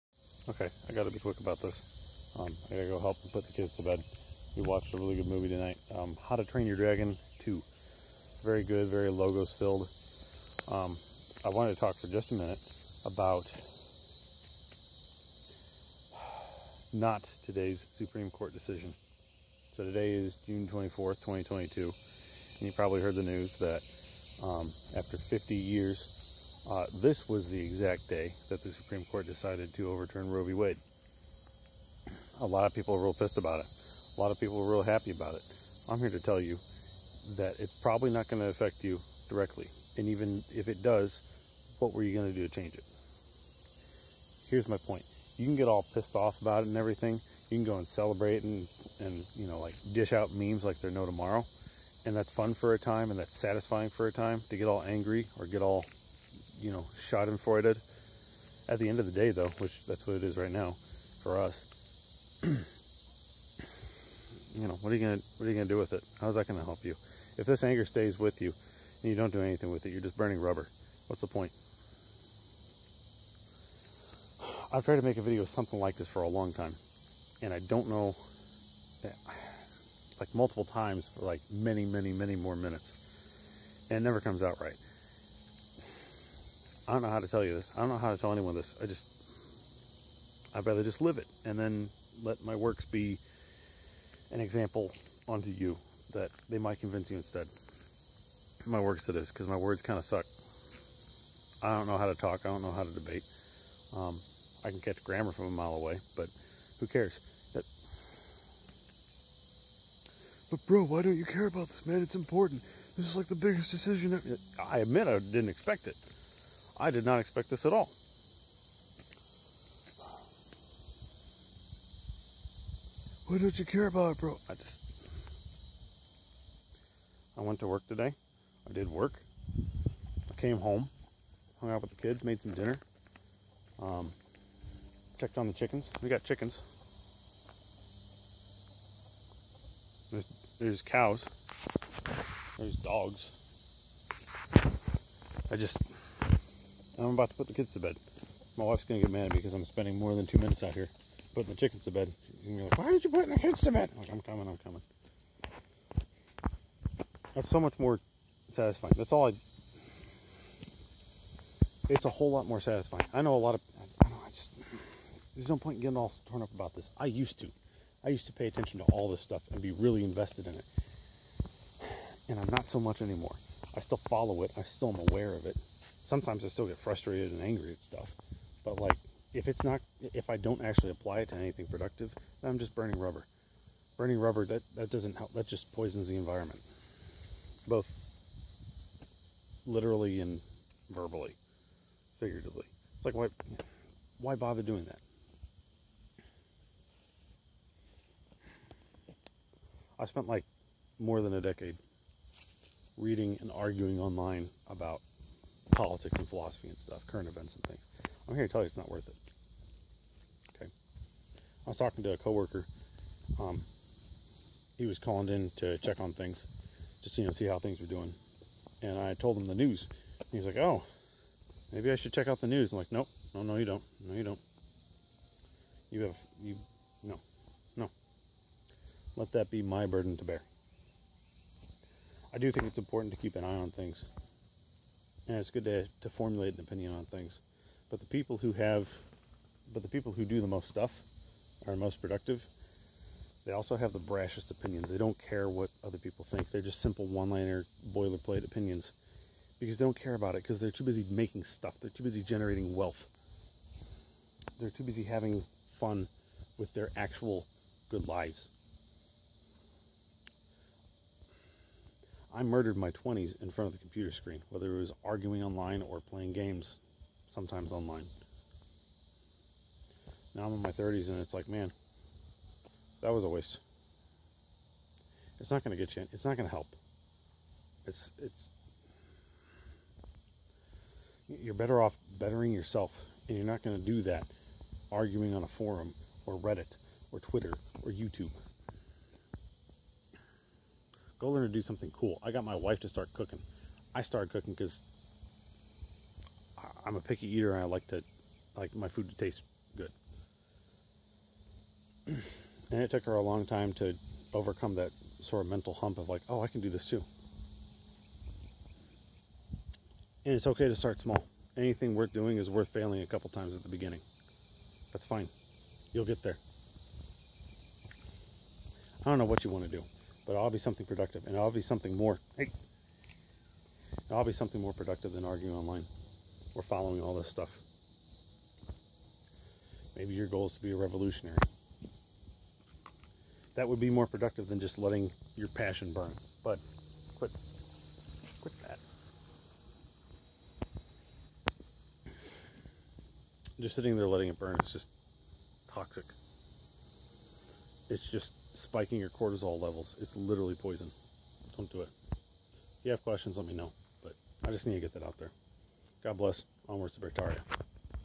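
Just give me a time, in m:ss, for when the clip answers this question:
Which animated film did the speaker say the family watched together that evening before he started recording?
0:06.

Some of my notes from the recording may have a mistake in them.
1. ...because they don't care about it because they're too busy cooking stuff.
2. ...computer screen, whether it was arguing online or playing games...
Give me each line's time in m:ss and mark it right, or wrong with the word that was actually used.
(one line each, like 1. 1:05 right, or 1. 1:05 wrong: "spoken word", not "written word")
1. 4:09 wrong: "making", not "cooking"
2. 4:23 right.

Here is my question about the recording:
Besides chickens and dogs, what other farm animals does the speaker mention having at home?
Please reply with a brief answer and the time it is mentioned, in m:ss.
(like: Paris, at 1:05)
cows, at 2:20.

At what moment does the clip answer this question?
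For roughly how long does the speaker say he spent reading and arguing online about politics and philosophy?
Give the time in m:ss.
3:20.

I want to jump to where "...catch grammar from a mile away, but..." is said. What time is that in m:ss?
1:44.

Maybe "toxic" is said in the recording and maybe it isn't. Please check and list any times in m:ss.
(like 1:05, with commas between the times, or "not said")
5:45.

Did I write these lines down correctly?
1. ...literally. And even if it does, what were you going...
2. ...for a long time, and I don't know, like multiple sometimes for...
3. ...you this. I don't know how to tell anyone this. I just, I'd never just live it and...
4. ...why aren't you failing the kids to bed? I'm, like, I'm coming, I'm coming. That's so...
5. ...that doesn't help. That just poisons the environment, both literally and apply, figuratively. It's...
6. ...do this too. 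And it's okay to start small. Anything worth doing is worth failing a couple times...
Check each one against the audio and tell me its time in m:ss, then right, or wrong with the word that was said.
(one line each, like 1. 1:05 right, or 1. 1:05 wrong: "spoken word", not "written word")
1. 0:39 wrong: "directly", not "literally"
2. 1:16 wrong: "times", not "sometimes"
3. 1:27 wrong: "rather", not "never"
4. 2:32 wrong: "putting", not "failing"
5. 3:04 wrong: "verbally", not "apply"
6. 5:06 right.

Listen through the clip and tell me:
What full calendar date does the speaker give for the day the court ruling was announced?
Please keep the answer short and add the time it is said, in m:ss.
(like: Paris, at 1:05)
June 24th, 2022, at 0:20.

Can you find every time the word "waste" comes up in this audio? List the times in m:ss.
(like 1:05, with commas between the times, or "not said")
4:33.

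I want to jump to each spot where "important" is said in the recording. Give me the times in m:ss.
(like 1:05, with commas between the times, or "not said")
1:52, 3:52.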